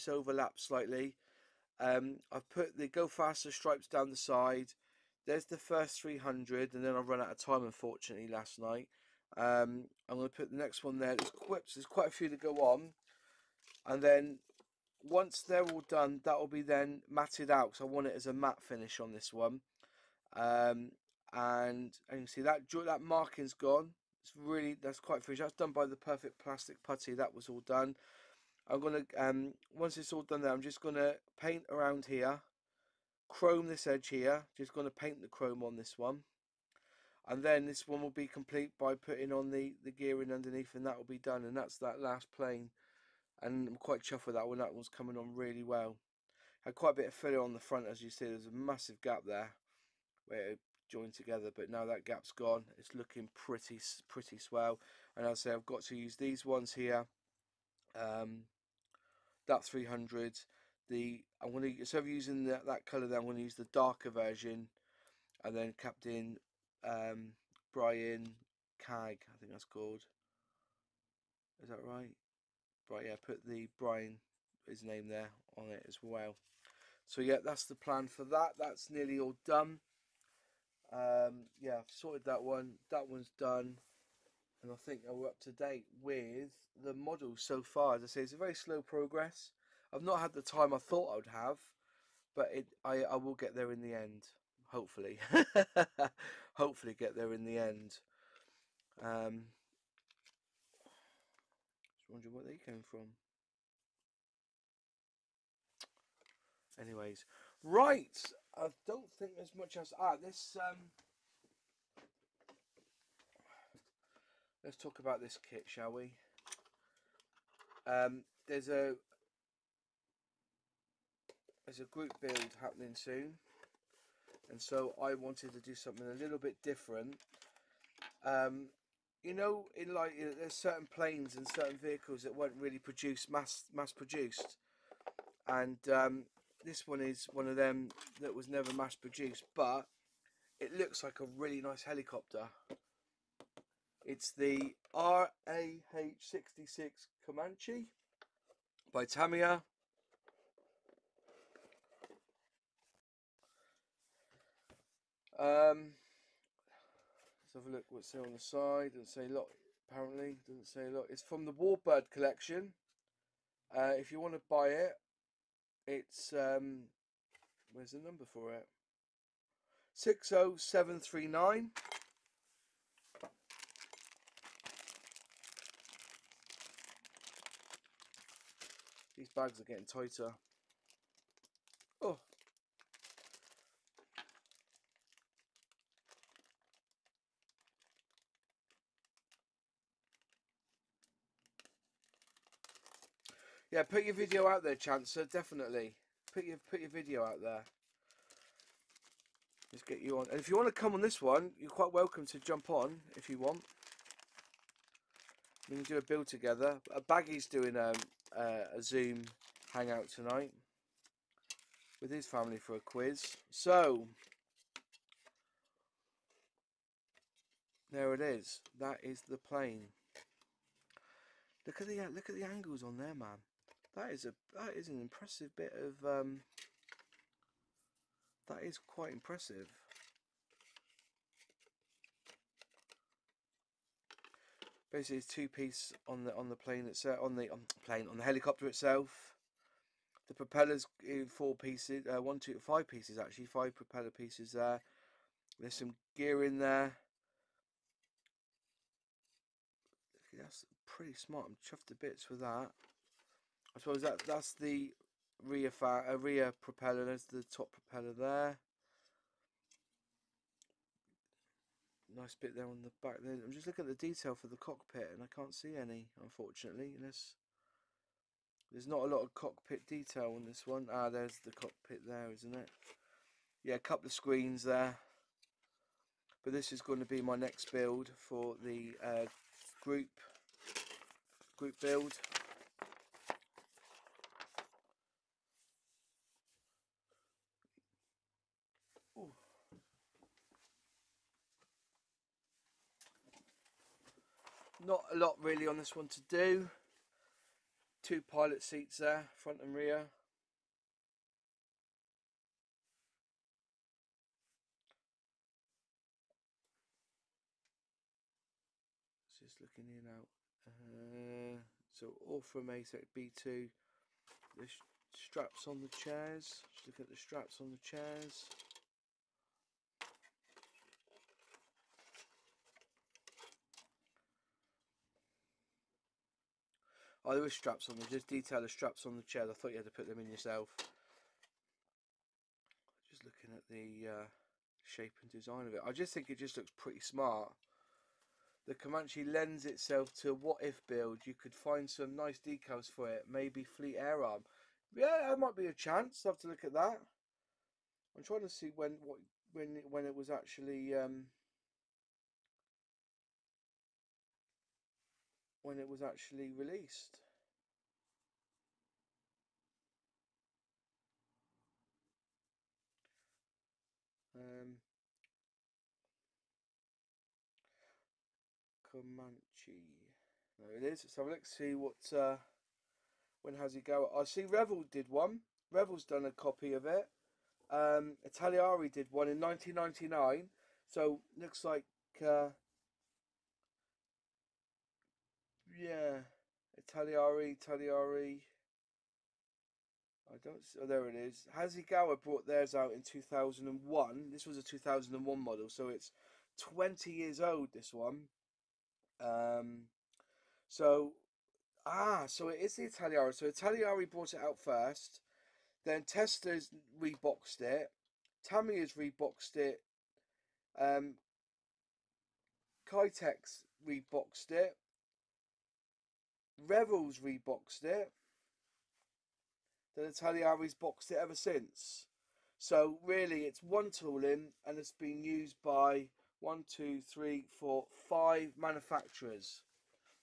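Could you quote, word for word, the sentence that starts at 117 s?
Um, there's a there's a group build happening soon, and so I wanted to do something a little bit different.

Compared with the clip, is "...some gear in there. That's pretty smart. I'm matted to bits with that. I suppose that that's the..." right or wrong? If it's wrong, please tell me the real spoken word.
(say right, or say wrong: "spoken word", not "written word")
wrong: "chuffed", not "matted".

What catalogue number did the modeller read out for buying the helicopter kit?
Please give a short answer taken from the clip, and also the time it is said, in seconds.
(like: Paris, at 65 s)
60739, at 169 s.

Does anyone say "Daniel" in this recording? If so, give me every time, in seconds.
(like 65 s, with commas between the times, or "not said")
not said.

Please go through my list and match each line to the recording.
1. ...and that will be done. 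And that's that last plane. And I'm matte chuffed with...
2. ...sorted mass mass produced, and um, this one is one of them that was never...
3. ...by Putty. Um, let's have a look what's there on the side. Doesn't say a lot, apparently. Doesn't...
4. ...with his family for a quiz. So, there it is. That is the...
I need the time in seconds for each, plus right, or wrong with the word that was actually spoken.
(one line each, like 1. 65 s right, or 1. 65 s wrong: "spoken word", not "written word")
1. 40 s wrong: "quite", not "matte"
2. 132 s wrong: "produced", not "sorted"
3. 148 s wrong: "Tamiya", not "Putty"
4. 211 s right.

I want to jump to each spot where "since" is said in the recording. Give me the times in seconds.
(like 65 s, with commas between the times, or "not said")
421 s.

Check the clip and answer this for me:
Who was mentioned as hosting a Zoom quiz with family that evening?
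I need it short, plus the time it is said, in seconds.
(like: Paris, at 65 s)
Baggy, at 207 s.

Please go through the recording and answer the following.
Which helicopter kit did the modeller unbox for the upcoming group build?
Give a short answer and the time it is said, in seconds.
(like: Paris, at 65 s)
RAH-66 Comanche, at 144 s.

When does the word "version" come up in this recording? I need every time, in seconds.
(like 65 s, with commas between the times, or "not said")
64 s.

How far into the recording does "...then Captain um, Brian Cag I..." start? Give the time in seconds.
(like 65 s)
65 s.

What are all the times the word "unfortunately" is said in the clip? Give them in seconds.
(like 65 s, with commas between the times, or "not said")
7 s, 266 s.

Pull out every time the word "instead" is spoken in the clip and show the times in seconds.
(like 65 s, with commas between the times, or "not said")
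61 s.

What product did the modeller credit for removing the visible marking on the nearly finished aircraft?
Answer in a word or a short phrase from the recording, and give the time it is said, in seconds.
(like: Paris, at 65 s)
Perfect Plastic Putty, at 25 s.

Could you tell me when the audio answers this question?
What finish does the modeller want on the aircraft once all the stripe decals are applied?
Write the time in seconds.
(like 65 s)
18 s.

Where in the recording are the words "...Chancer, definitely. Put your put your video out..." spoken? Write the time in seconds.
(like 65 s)
194 s.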